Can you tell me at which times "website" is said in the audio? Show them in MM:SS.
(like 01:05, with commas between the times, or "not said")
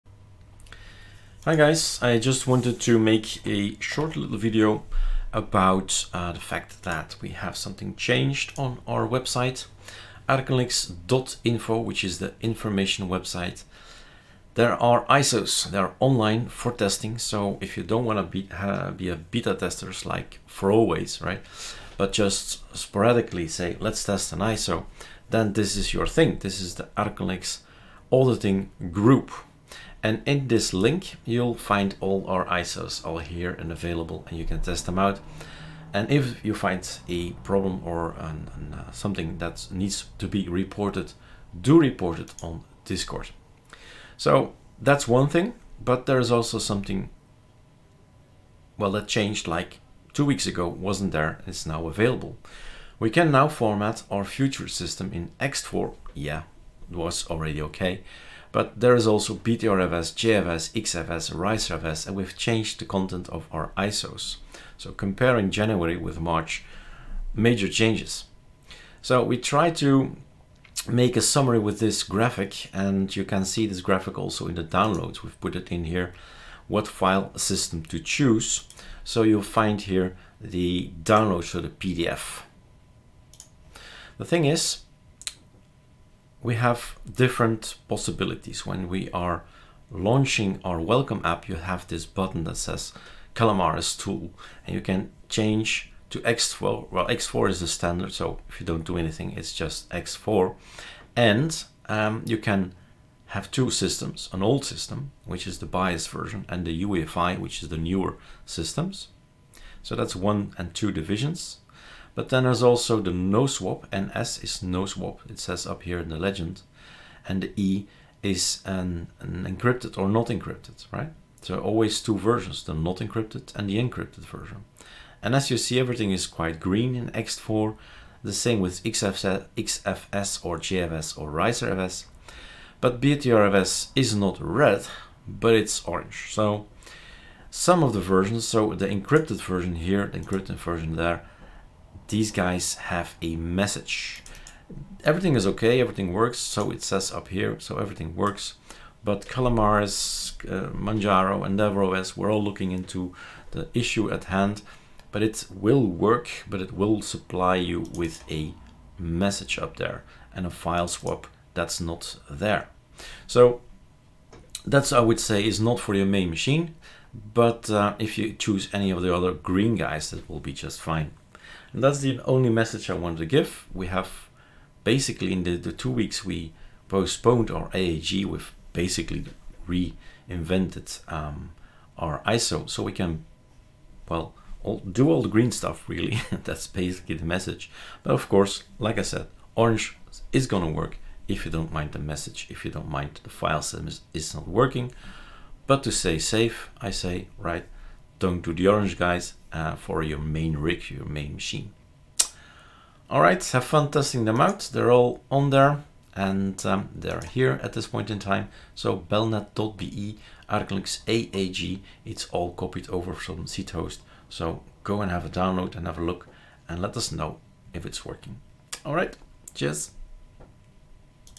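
00:09, 00:13.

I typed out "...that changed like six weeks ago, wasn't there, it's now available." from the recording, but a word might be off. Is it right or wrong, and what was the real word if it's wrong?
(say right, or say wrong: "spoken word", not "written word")
wrong: "two", not "six".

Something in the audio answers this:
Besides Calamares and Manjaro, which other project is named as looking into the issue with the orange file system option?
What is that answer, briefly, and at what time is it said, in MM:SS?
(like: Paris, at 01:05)
DevOS, at 02:31.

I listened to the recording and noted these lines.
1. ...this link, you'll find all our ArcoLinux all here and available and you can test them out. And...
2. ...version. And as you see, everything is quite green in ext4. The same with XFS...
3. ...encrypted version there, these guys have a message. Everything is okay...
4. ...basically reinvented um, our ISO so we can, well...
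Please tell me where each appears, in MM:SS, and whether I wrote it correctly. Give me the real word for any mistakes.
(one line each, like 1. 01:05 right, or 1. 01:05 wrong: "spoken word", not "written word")
1. 00:30 wrong: "ISOs", not "ArcoLinux"
2. 02:04 right
3. 02:20 right
4. 02:58 right.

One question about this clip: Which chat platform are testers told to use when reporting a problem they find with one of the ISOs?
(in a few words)
Discord.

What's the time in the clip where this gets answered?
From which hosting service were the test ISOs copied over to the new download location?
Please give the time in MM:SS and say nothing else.
03:33.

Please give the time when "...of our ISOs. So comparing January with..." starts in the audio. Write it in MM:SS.
01:03.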